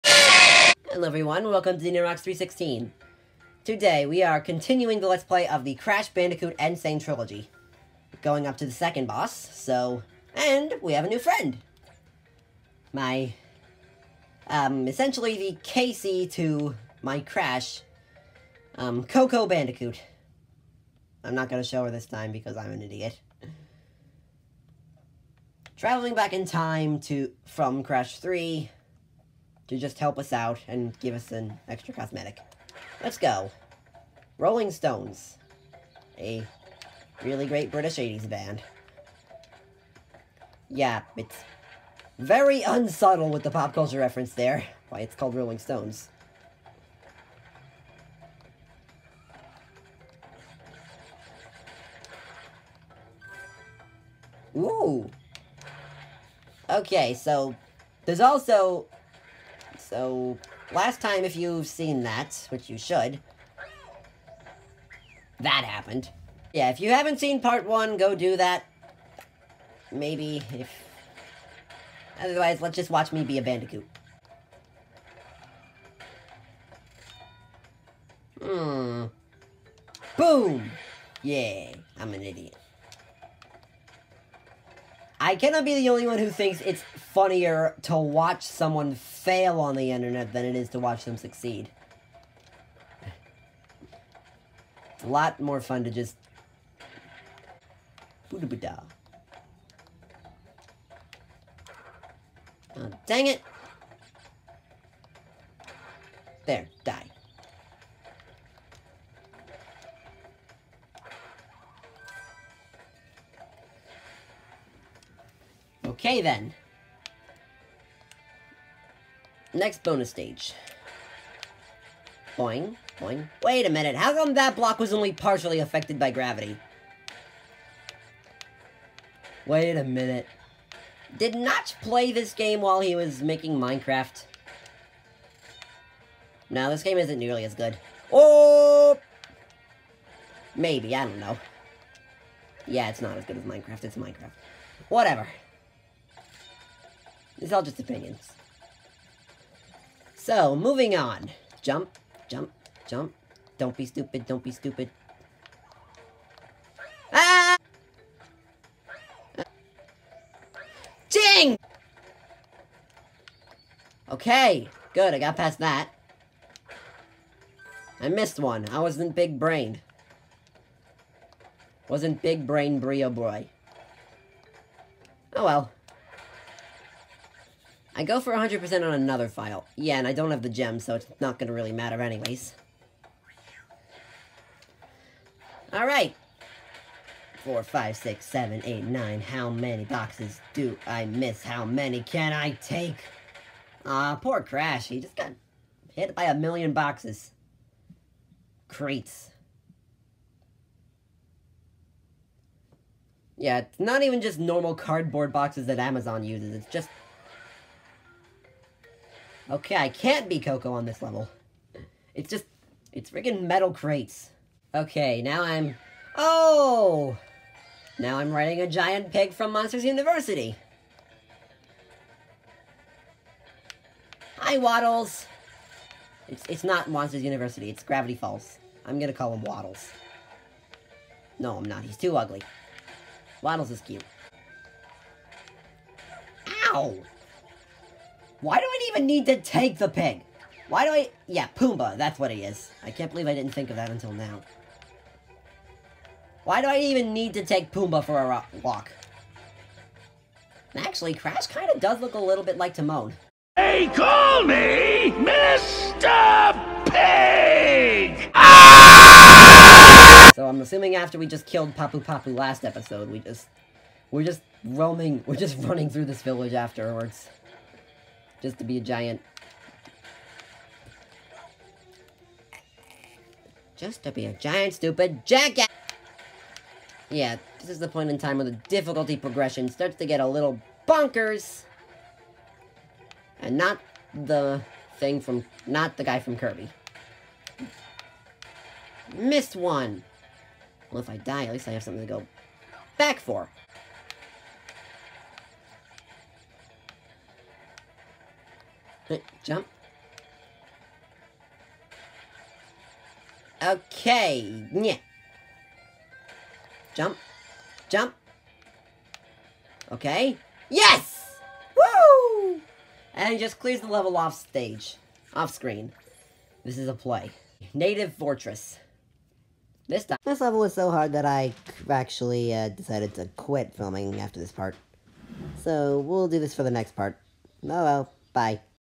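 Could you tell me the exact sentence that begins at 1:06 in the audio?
Yeah, if you haven't seen part one, go do that.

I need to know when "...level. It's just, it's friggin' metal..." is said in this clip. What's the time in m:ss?
3:31.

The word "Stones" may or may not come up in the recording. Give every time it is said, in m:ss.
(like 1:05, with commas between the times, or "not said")
0:34, 0:45.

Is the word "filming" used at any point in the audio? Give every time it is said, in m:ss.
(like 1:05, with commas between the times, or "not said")
5:23.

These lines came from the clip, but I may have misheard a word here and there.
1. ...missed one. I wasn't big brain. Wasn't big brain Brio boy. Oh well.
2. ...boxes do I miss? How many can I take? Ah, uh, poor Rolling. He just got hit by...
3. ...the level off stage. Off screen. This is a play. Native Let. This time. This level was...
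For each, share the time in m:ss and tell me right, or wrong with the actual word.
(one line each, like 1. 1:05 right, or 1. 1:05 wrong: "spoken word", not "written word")
1. 2:48 right
2. 3:09 wrong: "Crash", not "Rolling"
3. 5:13 wrong: "Fortress", not "Let".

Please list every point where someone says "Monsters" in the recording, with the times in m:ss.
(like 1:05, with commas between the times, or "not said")
3:39, 3:46.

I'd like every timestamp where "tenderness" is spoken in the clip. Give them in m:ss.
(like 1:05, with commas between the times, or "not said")
not said.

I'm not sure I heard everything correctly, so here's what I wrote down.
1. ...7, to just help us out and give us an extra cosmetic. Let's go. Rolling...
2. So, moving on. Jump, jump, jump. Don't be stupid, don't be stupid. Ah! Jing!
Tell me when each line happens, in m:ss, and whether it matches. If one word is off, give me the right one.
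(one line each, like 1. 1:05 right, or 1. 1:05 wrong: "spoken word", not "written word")
1. 0:28 wrong: "3", not "7"
2. 2:30 right.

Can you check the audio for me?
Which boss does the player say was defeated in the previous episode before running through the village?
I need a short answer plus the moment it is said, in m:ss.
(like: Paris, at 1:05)
Papu Papu, at 4:21.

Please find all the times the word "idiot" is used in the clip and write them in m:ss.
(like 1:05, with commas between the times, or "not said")
0:22, 1:22.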